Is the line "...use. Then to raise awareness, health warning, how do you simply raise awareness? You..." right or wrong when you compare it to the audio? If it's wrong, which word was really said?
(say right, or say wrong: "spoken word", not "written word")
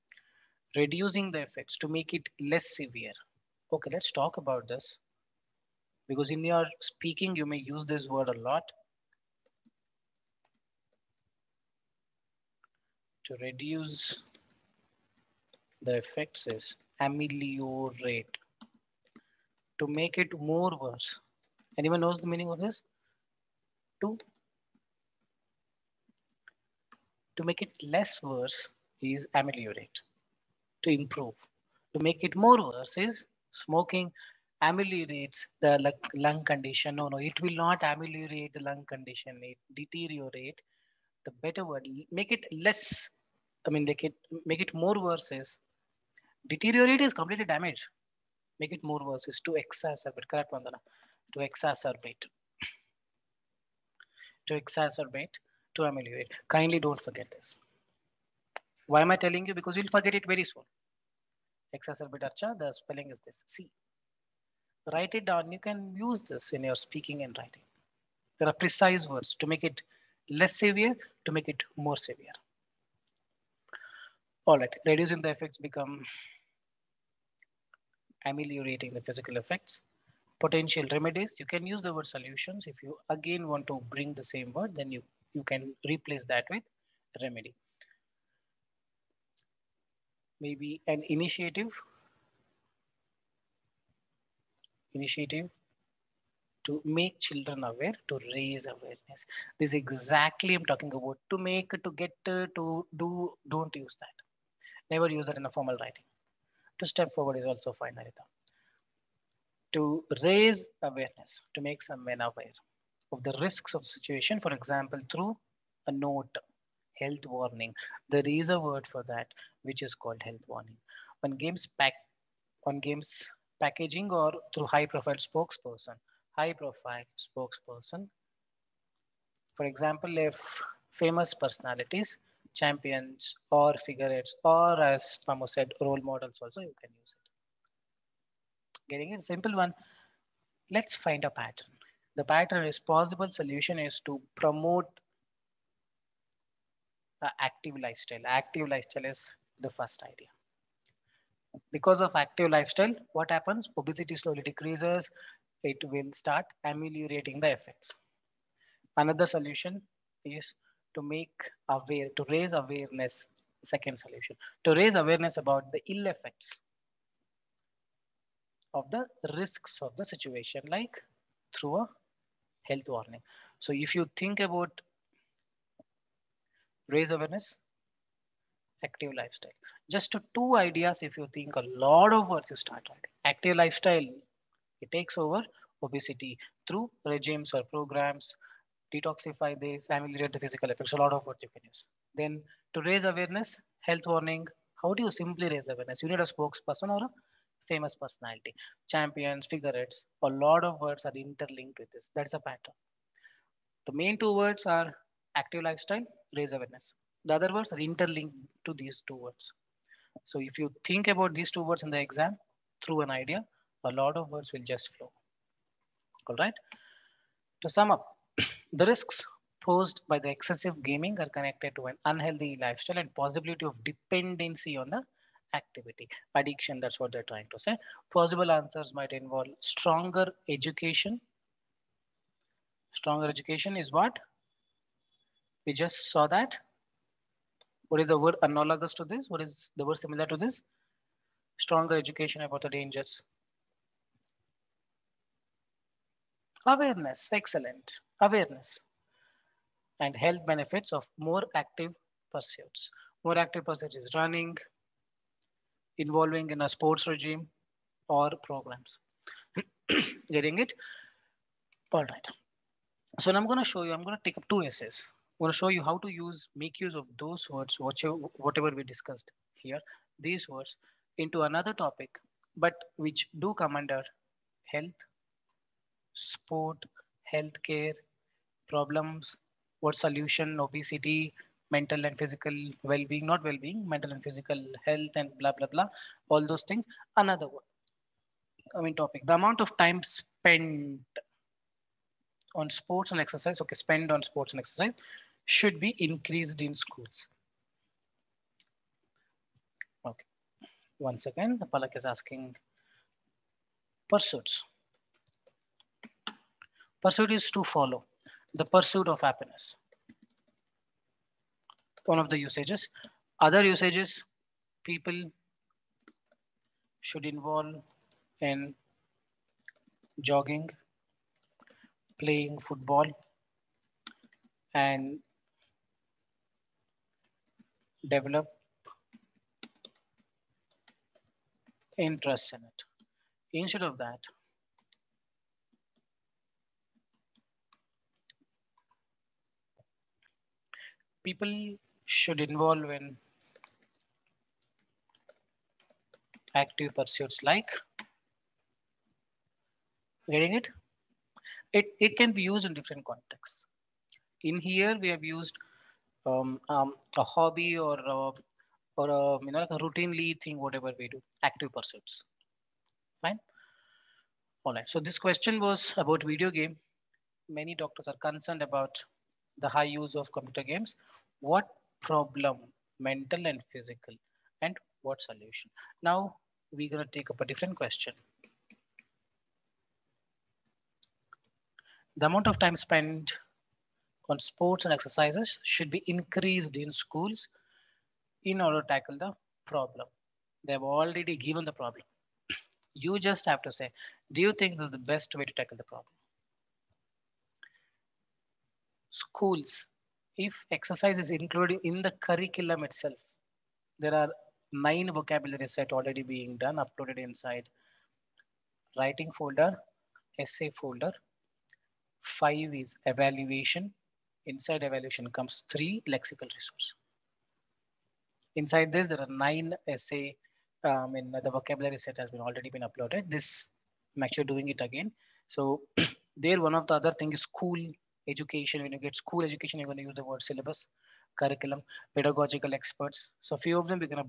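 right.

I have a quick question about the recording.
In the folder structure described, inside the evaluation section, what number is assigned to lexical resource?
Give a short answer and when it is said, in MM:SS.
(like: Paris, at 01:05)
3, at 06:55.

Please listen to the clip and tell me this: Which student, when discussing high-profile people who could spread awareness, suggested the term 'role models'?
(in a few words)
Pamo.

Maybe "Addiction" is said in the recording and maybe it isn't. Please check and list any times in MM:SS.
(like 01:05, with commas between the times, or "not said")
03:46.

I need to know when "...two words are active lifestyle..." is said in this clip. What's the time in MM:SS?
03:24.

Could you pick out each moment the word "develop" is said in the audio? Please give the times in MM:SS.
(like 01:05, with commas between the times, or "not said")
05:28.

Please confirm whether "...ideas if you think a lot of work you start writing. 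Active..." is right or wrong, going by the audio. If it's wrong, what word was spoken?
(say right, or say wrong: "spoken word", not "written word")
right.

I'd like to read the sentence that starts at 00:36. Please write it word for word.
No, no, it will not ameliorate the lung condition.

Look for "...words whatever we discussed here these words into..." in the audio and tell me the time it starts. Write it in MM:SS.
04:27.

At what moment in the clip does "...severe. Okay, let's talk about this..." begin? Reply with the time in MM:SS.
00:02.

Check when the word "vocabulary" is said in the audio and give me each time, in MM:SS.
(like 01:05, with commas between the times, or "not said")
06:45, 07:01.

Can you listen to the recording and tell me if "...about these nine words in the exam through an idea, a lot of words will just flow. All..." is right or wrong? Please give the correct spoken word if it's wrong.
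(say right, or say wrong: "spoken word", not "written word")
wrong: "two", not "nine".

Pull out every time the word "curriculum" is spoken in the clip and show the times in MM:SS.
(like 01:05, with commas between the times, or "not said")
06:42, 07:11.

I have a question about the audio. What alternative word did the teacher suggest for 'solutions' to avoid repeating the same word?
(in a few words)
remedy.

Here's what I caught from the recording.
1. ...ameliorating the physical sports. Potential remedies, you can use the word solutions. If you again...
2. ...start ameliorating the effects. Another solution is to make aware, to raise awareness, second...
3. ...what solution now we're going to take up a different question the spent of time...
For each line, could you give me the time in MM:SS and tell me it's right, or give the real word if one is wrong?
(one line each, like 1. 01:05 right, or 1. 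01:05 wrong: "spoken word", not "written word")
1. 01:18 wrong: "effects", not "sports"
2. 02:36 right
3. 06:15 wrong: "amount", not "spent".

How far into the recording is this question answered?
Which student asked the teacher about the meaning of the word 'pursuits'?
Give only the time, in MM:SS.
05:01.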